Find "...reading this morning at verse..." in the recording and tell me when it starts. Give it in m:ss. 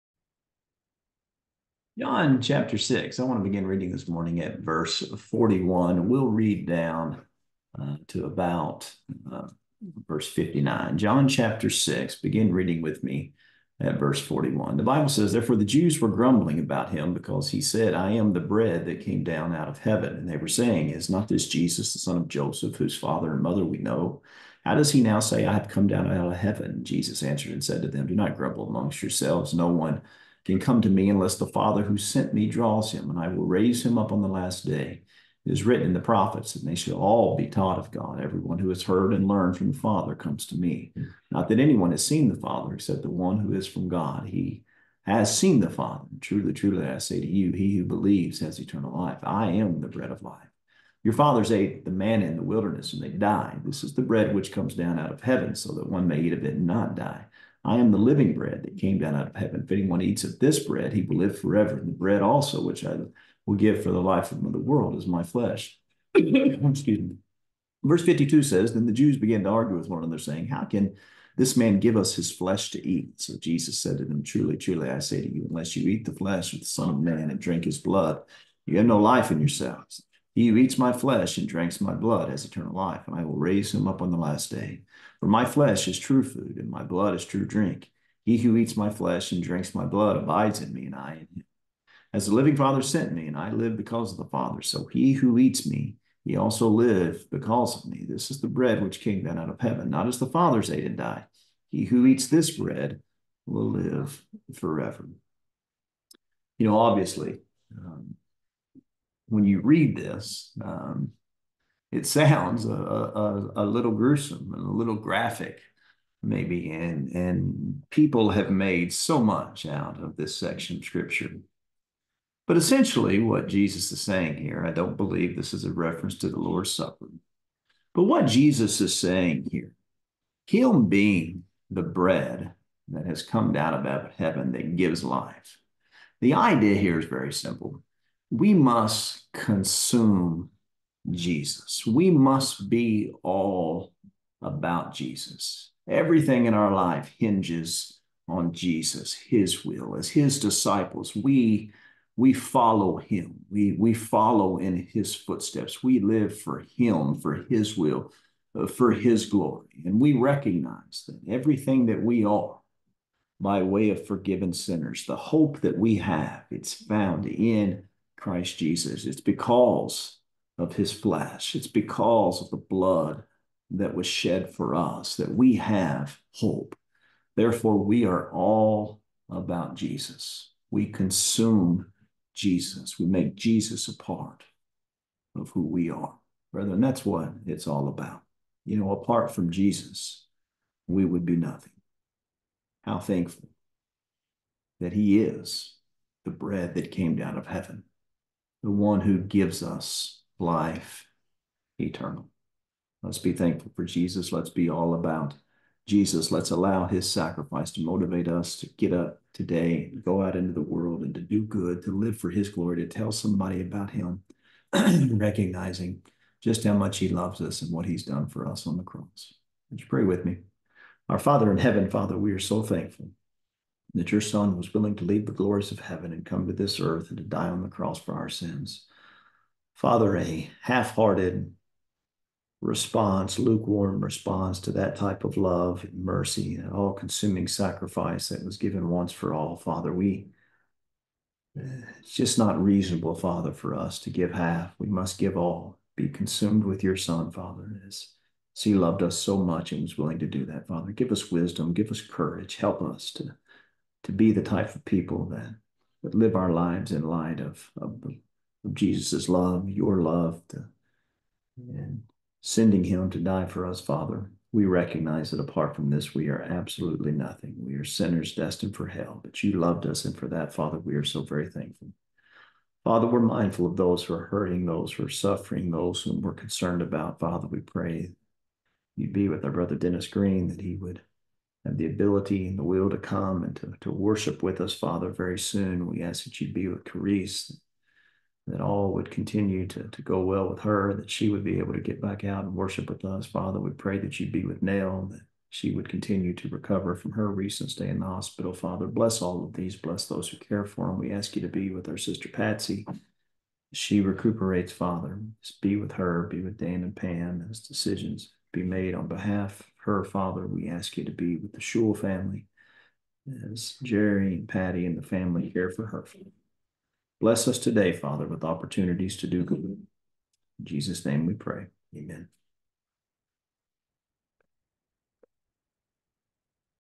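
0:03.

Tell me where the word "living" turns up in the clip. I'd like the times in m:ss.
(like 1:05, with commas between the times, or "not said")
0:57, 1:32.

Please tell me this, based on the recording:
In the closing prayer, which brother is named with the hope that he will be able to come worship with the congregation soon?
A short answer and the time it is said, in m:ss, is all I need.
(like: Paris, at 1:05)
Dennis Green, at 4:39.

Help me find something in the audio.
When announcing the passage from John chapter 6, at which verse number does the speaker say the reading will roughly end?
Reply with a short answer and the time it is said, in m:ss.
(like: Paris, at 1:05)
59, at 0:10.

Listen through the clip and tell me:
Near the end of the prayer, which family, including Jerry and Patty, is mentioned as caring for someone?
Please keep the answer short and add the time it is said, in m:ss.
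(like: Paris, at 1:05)
Shule, at 5:11.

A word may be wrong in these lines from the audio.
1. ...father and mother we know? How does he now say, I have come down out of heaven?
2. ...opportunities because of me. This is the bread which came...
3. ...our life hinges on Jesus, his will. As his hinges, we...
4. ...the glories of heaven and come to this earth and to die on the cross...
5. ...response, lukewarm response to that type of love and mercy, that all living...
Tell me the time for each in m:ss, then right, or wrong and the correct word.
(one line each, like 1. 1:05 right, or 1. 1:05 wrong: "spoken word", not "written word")
1. 0:22 right
2. 1:36 wrong: "lives", not "opportunities"
3. 2:26 wrong: "disciples", not "hinges"
4. 3:45 right
5. 3:52 wrong: "consuming", not "living".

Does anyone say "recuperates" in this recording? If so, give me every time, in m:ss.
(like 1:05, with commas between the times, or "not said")
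5:04.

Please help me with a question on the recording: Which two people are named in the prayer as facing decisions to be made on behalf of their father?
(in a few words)
Dan and Pam.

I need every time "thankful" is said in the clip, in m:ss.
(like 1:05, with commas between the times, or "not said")
3:12, 3:23, 3:42, 4:31.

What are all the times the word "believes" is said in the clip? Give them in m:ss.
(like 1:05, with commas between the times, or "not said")
0:47, 2:04.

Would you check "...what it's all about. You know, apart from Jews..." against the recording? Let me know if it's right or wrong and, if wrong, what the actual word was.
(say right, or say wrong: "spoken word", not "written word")
wrong: "Jesus", not "Jews".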